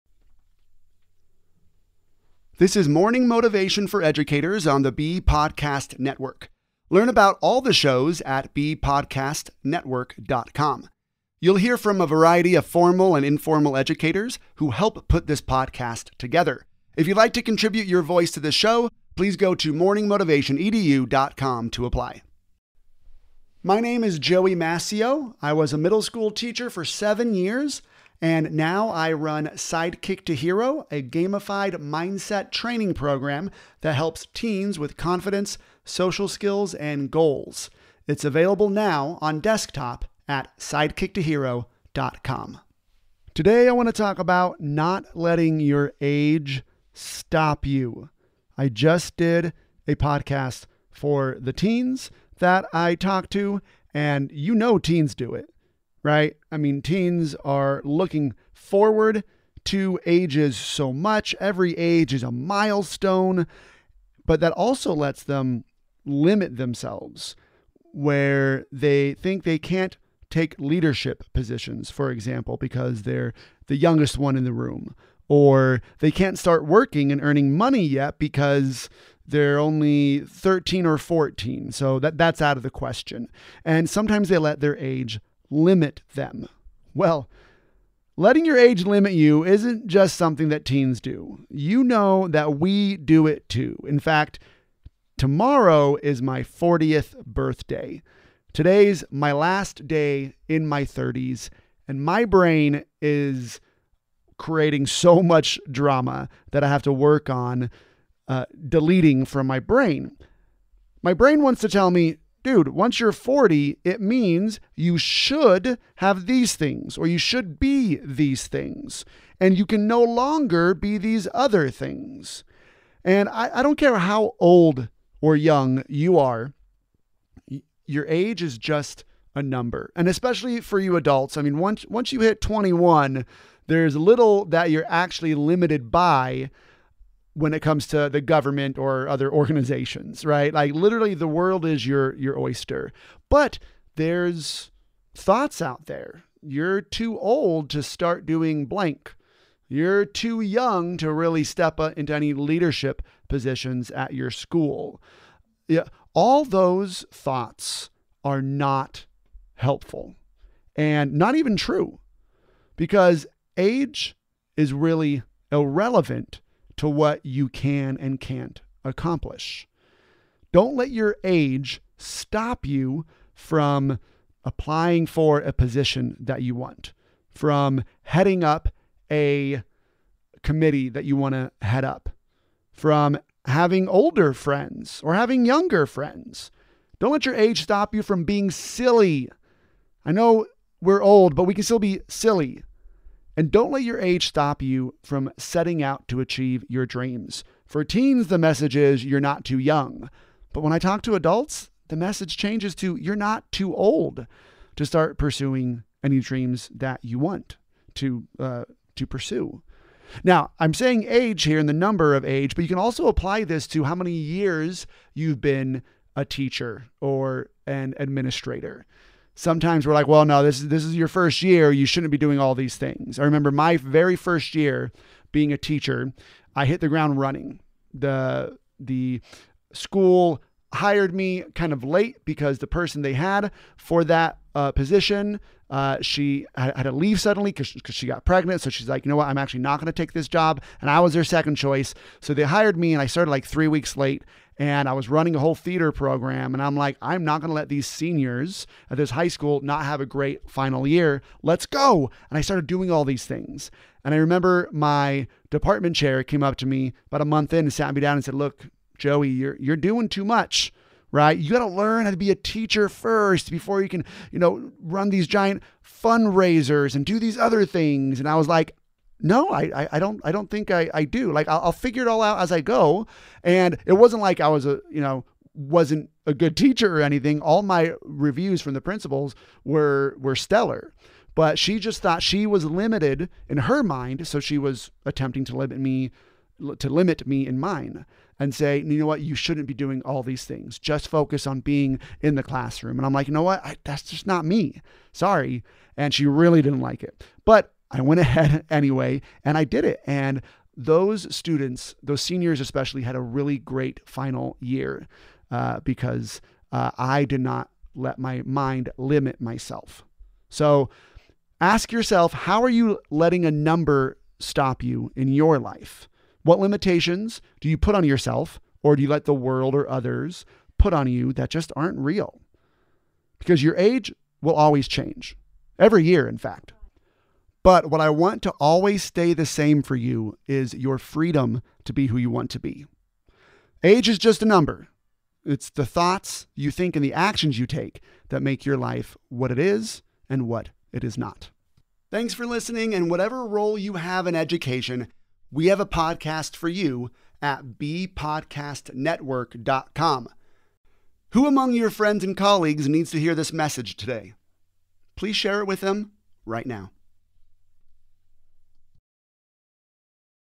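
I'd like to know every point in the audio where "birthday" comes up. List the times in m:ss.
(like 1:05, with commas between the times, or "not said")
1:37.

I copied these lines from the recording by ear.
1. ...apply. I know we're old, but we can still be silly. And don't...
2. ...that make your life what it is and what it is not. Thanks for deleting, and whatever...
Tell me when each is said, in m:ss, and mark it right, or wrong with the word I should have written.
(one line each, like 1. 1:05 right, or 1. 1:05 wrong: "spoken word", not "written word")
1. 3:08 wrong: "silly", not "apply"
2. 5:38 wrong: "listening", not "deleting".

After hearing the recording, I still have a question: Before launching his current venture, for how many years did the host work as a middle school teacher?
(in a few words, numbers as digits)
7.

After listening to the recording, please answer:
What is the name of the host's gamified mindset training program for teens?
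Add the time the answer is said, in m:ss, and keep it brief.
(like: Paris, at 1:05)
Sidekick to Hero, at 0:29.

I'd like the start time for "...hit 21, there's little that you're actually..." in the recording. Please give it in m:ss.
2:12.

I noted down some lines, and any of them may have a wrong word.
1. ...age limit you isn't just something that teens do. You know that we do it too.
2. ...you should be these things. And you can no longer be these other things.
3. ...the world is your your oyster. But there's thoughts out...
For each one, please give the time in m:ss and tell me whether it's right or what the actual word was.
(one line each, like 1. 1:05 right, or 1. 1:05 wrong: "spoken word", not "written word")
1. 1:28 right
2. 1:57 right
3. 2:21 right.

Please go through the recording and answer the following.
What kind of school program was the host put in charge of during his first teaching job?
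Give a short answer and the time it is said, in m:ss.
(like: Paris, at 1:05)
Theater program, at 4:05.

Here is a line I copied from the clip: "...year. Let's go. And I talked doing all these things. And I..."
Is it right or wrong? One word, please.
wrong.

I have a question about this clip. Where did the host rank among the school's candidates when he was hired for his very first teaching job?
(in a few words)
Second choice.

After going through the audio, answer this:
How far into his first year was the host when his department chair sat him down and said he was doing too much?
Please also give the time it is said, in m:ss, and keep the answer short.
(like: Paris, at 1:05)
A month, at 4:17.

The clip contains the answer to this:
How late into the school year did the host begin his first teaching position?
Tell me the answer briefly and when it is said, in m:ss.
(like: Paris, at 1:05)
Three weeks, at 4:03.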